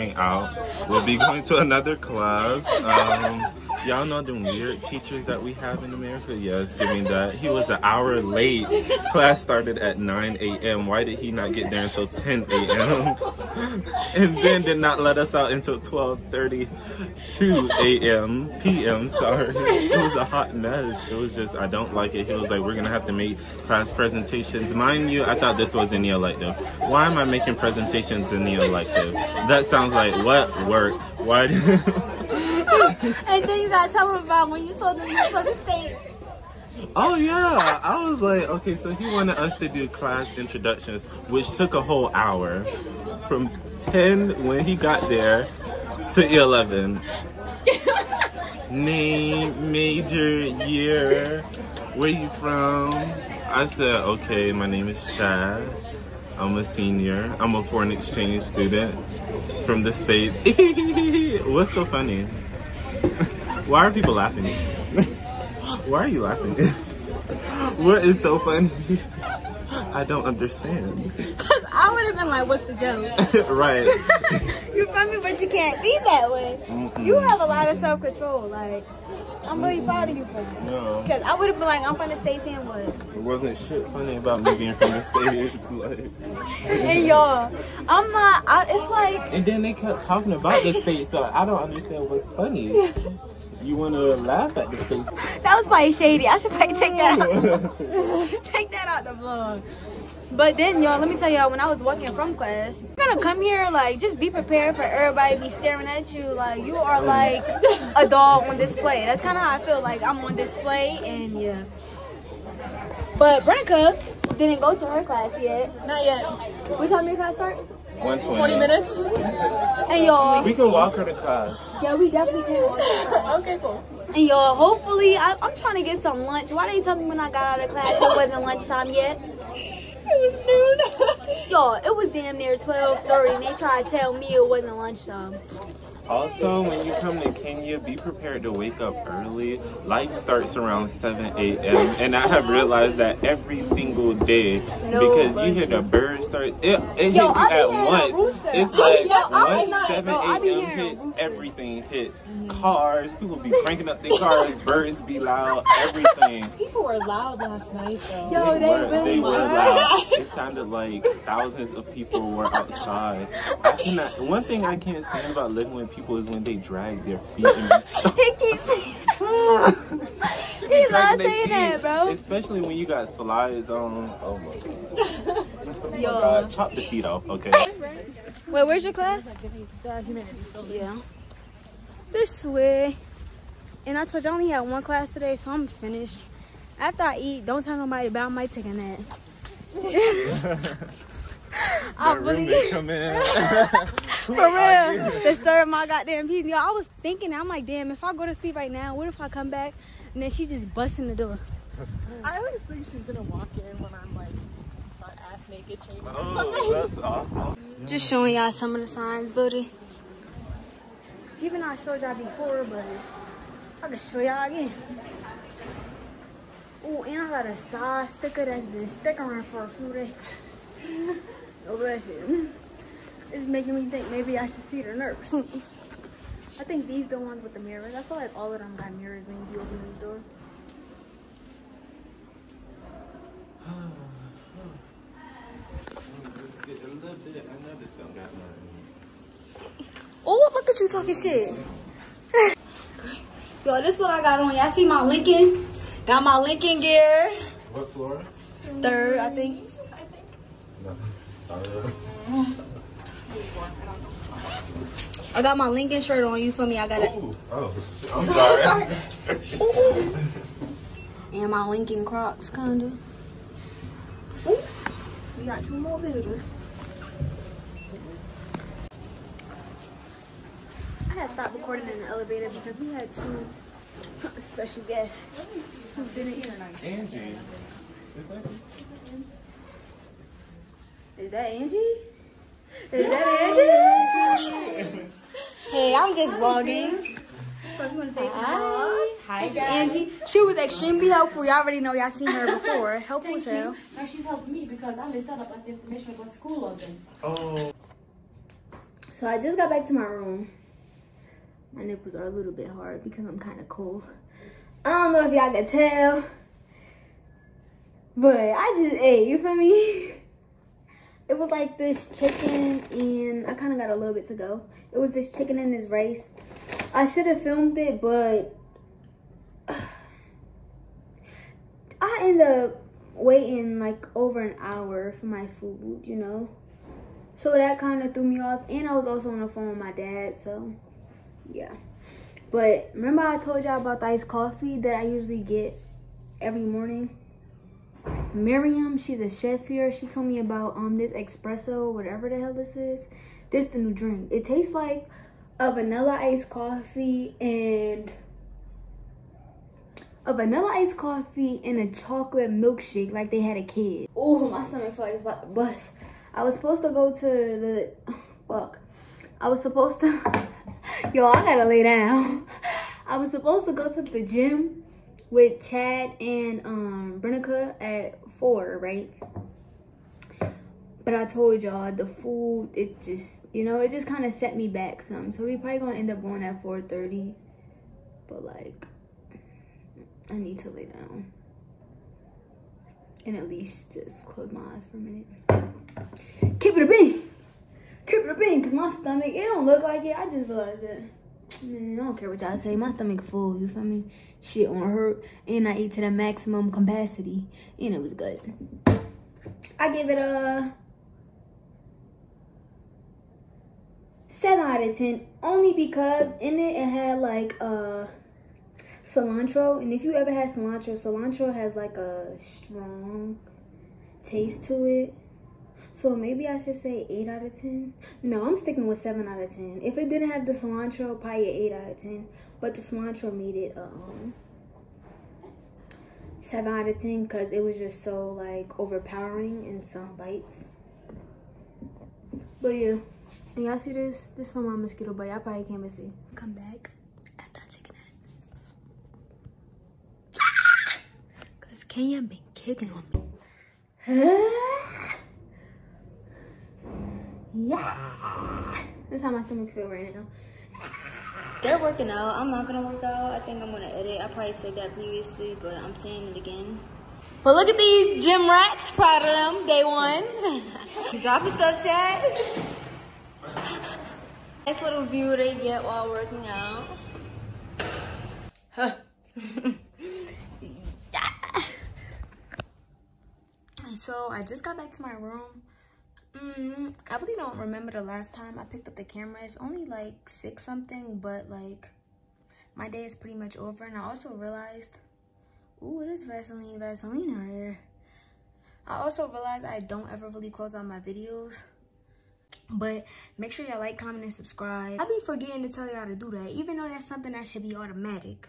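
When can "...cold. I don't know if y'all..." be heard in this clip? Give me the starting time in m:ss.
5:03.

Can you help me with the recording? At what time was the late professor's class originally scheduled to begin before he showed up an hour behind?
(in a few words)
9 a.m.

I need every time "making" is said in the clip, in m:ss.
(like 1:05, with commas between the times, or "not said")
0:27, 3:43.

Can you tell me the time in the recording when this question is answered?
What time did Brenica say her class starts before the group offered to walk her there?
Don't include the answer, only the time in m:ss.
1:58.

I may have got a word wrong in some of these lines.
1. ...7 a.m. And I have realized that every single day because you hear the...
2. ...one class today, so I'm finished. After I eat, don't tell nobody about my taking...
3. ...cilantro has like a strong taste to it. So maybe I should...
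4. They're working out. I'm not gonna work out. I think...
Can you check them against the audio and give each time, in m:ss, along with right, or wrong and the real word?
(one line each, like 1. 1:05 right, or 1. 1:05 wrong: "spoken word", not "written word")
1. 2:20 right
2. 3:04 right
3. 6:50 right
4. 7:31 right.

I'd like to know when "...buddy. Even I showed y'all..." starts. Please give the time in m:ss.
3:29.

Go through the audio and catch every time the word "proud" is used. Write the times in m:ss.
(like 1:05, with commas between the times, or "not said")
1:19, 7:38.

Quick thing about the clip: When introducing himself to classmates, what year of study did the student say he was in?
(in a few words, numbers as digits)
Senior.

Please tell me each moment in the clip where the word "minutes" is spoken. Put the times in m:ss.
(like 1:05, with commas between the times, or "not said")
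1:58, 6:24.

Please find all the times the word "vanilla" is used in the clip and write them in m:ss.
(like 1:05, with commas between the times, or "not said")
5:45, 5:50.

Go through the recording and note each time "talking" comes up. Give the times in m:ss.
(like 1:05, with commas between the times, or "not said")
1:30, 4:00.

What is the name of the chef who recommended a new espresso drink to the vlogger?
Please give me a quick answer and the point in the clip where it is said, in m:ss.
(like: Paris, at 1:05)
Miriam, at 5:38.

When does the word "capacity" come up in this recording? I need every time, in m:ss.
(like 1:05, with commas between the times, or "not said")
6:36.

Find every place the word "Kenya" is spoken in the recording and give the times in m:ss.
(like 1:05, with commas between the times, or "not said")
2:17, 7:21.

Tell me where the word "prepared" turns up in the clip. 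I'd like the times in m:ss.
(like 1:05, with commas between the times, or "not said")
1:44, 2:17.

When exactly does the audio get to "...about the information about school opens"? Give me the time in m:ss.
4:55.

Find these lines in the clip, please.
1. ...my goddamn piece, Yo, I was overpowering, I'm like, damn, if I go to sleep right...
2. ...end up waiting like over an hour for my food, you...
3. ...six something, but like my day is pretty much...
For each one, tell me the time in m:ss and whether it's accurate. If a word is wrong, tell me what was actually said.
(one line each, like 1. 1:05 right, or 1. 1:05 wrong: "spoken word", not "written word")
1. 3:15 wrong: "thinking", not "overpowering"
2. 5:22 right
3. 8:00 right.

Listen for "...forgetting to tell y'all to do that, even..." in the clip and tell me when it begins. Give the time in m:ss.
8:15.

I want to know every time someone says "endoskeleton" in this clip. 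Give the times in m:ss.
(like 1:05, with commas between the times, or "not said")
not said.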